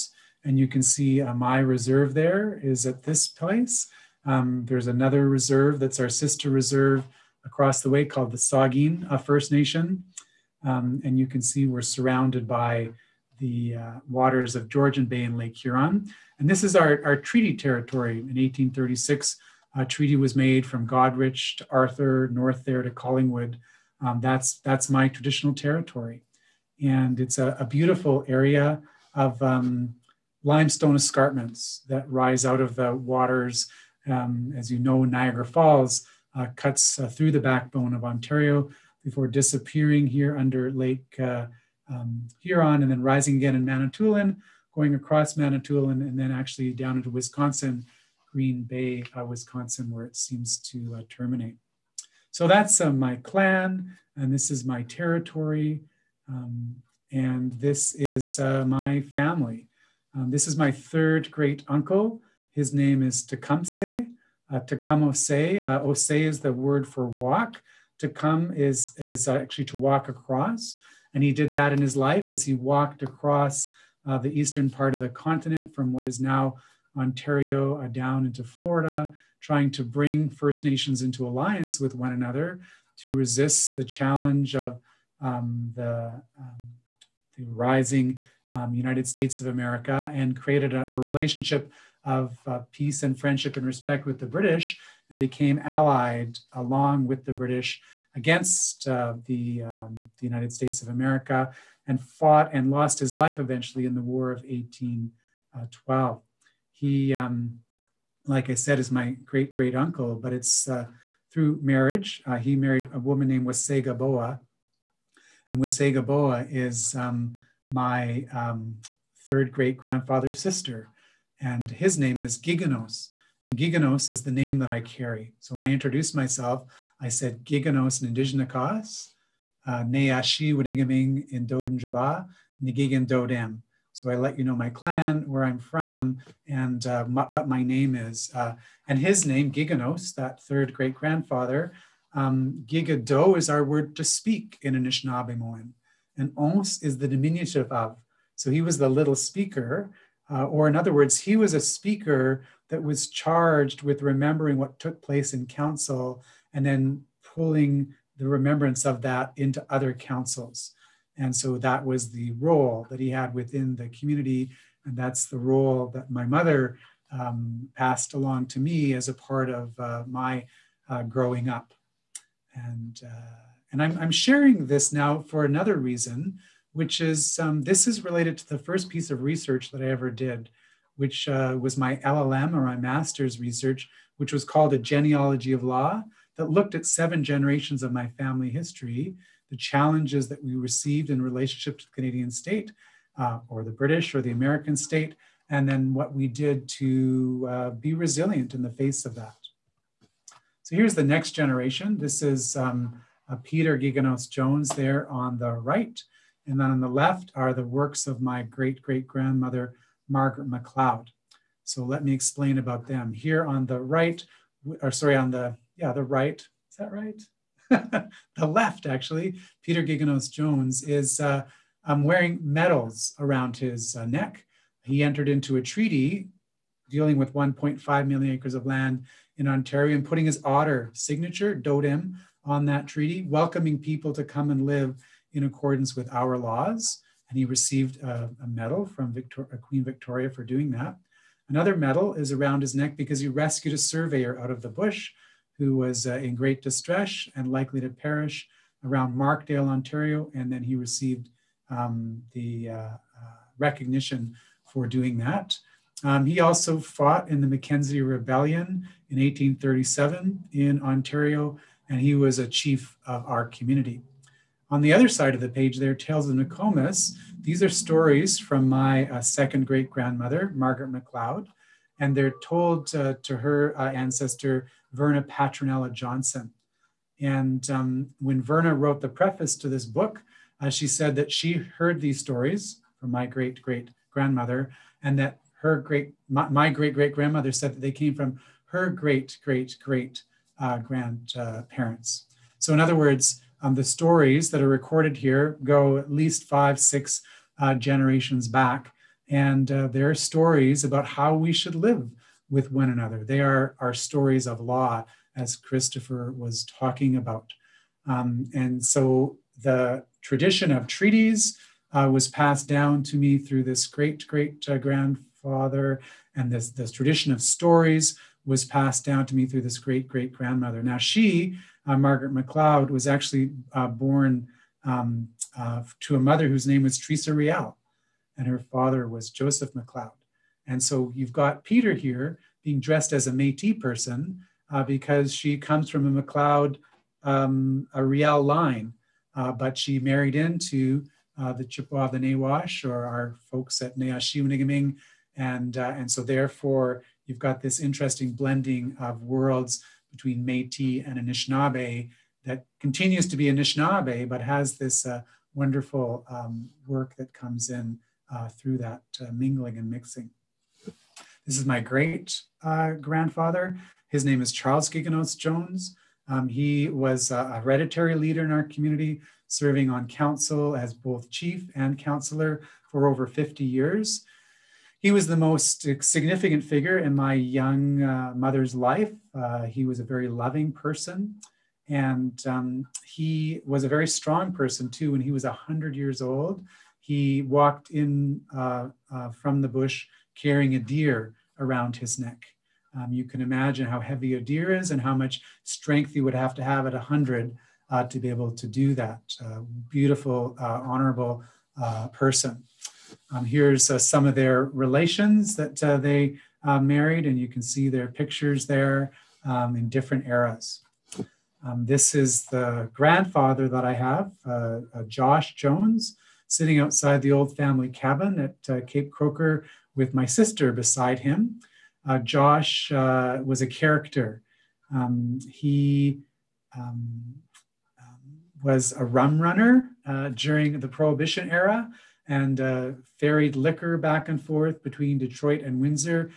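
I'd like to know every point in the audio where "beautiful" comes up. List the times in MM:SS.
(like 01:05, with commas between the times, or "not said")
00:27, 06:39.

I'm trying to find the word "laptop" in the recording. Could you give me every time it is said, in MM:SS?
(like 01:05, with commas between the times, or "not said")
not said.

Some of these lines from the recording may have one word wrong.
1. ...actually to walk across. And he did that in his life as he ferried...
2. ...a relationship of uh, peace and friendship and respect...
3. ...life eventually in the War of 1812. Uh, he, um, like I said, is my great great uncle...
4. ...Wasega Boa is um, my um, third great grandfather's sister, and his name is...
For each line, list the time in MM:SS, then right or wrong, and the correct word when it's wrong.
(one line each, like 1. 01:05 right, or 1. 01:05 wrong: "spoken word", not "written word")
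1. 01:09 wrong: "walked", not "ferried"
2. 01:30 right
3. 01:43 right
4. 01:55 right.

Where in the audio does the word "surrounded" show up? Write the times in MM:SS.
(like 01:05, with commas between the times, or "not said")
00:11.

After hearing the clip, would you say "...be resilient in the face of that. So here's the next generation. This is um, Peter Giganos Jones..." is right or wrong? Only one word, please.
right.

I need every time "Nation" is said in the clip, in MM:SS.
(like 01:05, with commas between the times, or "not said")
00:09, 01:20.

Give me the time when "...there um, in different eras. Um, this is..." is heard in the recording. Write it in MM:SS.
06:48.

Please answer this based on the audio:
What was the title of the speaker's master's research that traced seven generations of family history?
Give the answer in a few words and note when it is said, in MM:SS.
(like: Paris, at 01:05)
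A Genealogy of Law, at 03:04.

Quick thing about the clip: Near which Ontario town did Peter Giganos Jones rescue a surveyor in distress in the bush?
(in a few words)
Markdale.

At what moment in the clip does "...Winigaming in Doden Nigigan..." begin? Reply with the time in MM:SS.
02:10.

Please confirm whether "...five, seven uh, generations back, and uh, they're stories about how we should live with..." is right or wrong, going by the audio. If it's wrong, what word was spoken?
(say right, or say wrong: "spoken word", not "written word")
wrong: "six", not "seven".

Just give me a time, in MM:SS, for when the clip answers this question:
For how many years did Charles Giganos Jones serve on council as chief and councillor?
06:13.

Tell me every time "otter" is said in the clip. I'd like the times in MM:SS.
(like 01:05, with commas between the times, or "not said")
03:50.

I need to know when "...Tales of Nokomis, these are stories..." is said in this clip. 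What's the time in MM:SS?
04:25.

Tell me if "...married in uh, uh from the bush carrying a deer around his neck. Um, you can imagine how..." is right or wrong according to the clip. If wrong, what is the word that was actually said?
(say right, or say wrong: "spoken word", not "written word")
wrong: "walked", not "married".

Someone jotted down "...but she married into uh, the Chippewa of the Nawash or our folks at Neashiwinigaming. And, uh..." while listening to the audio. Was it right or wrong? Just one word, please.
right.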